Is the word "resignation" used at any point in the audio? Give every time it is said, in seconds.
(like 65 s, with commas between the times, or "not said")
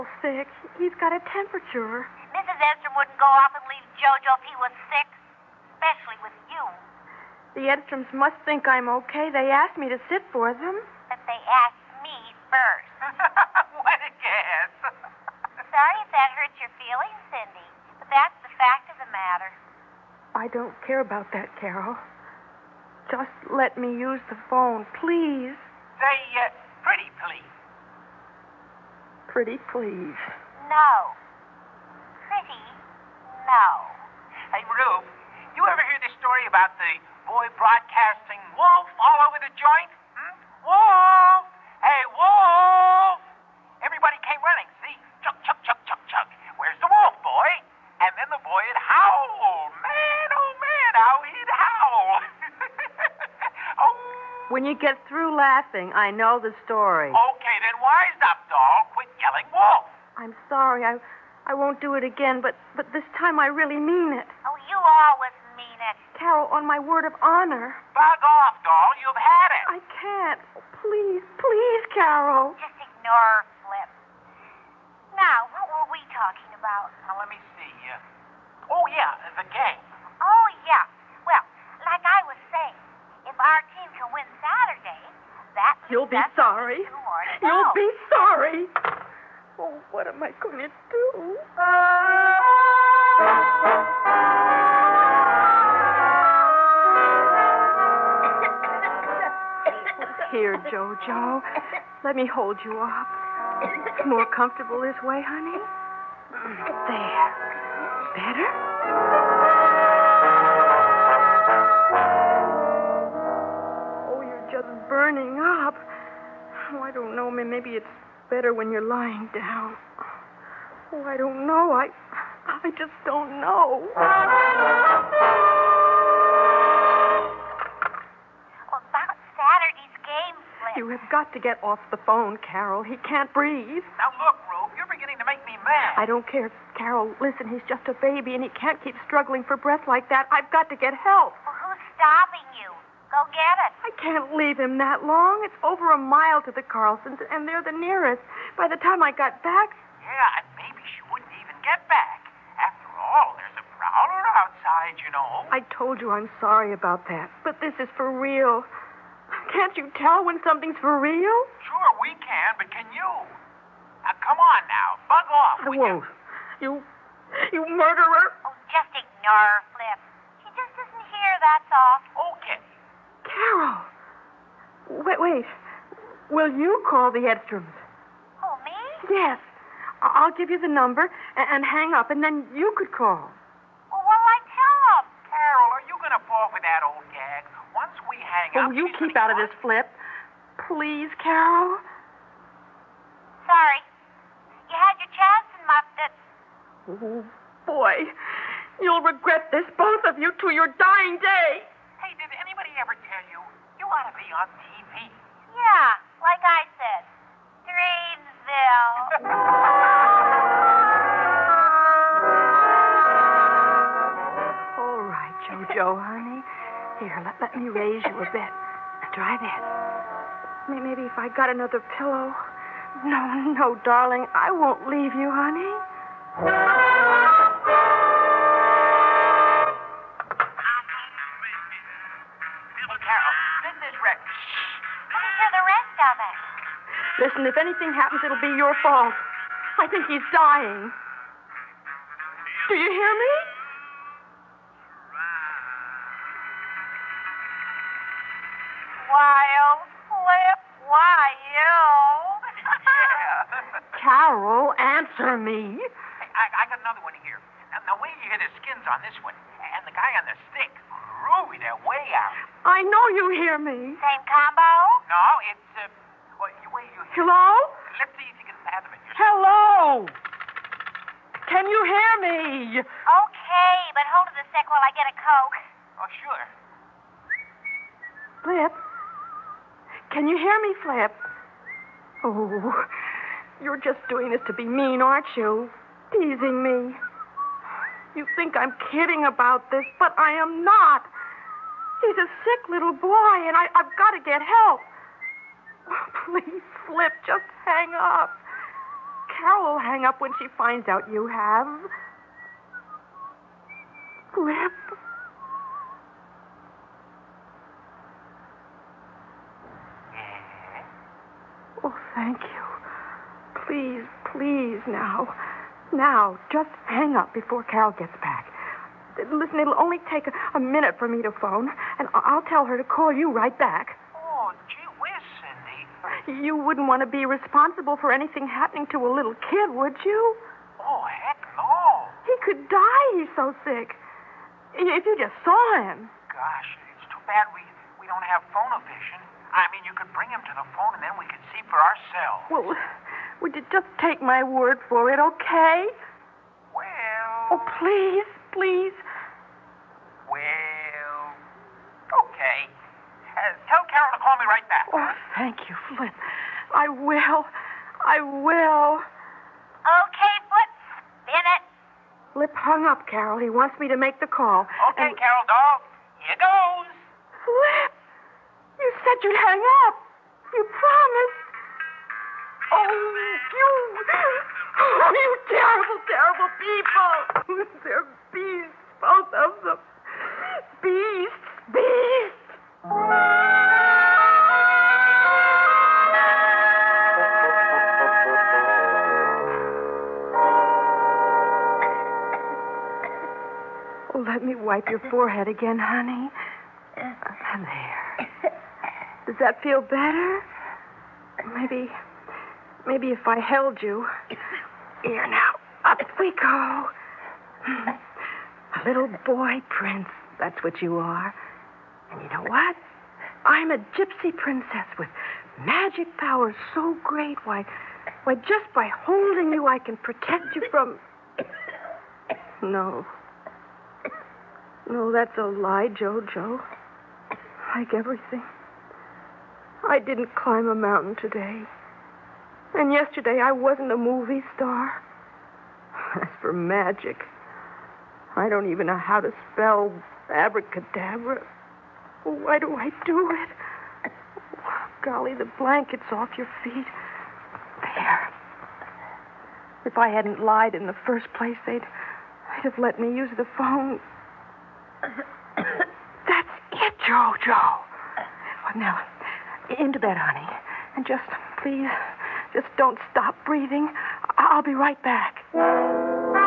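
not said.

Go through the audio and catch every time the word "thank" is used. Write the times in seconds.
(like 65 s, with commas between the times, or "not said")
312 s, 355 s.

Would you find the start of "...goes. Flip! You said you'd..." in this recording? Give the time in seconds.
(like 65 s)
366 s.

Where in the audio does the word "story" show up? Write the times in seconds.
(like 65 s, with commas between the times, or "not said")
36 s, 56 s.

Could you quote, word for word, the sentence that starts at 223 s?
No, no, darling, I won't leave you, honey.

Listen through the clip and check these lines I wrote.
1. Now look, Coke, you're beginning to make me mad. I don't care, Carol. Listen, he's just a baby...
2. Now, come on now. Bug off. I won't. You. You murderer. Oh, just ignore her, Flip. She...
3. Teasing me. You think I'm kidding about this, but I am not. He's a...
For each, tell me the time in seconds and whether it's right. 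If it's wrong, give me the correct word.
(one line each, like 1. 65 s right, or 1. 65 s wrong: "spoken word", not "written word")
1. 133 s wrong: "Rube", not "Coke"
2. 164 s right
3. 286 s right.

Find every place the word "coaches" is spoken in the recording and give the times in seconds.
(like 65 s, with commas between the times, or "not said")
not said.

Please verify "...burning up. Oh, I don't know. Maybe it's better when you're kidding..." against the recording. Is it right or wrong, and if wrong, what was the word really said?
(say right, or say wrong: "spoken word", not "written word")
wrong: "lying", not "kidding".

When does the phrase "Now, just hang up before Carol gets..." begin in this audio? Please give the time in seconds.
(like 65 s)
315 s.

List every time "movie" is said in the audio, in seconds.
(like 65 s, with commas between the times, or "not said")
433 s.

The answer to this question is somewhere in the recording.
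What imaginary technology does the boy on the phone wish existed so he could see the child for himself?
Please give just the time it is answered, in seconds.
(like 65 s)
338 s.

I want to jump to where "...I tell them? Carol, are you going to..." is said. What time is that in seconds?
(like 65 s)
184 s.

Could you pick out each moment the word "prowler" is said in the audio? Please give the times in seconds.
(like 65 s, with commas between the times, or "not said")
153 s.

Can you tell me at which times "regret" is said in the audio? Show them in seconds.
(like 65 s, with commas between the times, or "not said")
199 s.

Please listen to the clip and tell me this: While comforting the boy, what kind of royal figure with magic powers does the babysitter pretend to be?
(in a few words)
Gypsy princess.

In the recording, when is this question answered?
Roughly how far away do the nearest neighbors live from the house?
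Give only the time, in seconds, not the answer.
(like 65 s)
145 s.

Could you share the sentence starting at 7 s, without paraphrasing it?
The Edstroms must think I'm okay.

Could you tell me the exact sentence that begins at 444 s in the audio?
Oh, golly, the blanket's off your feet.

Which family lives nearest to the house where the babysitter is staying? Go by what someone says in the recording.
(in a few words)
The Carlsons.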